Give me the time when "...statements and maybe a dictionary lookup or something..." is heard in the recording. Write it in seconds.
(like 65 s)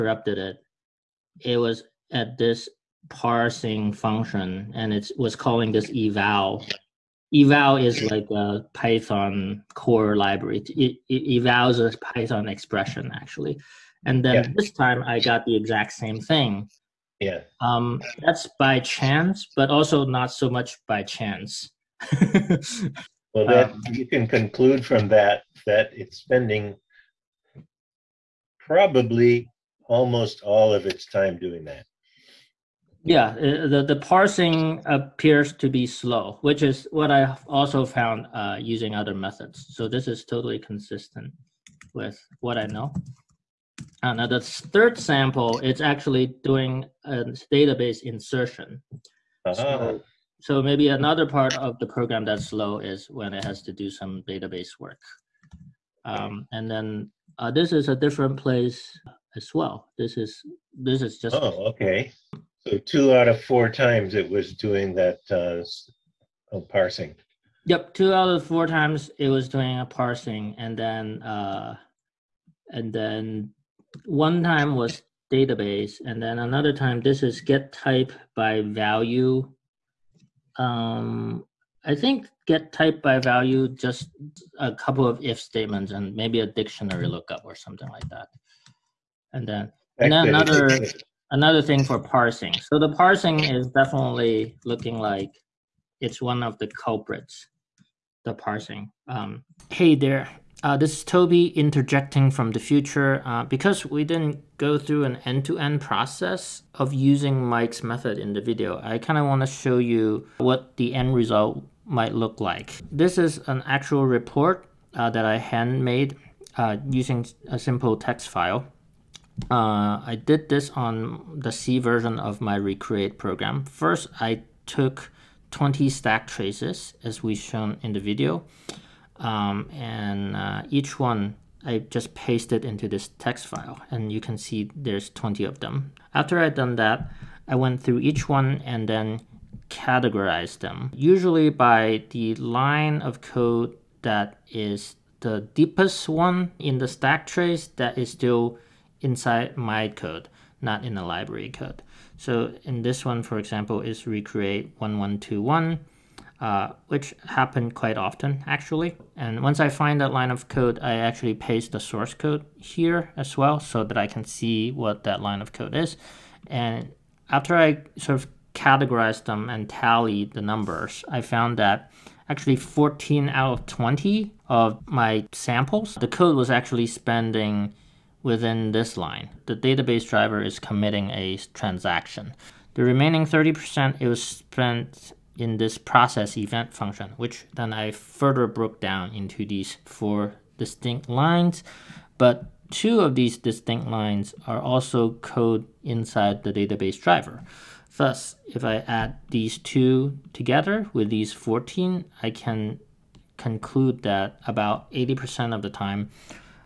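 85 s.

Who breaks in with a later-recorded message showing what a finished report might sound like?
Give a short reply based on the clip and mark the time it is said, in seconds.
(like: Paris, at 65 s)
Toby, at 101 s.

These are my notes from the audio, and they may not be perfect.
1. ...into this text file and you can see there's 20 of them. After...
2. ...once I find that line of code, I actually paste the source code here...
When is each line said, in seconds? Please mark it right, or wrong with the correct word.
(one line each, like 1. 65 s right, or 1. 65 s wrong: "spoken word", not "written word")
1. 132 s right
2. 159 s right.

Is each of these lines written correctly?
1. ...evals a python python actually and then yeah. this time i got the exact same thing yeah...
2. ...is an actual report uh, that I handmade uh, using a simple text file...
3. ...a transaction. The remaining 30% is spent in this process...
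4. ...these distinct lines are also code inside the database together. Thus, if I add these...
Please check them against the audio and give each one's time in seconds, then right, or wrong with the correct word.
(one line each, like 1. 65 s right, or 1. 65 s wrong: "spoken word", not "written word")
1. 11 s wrong: "expression", not "python"
2. 113 s right
3. 181 s right
4. 193 s wrong: "driver", not "together".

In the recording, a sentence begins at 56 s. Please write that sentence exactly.
Um, and then uh, this is a different place as well.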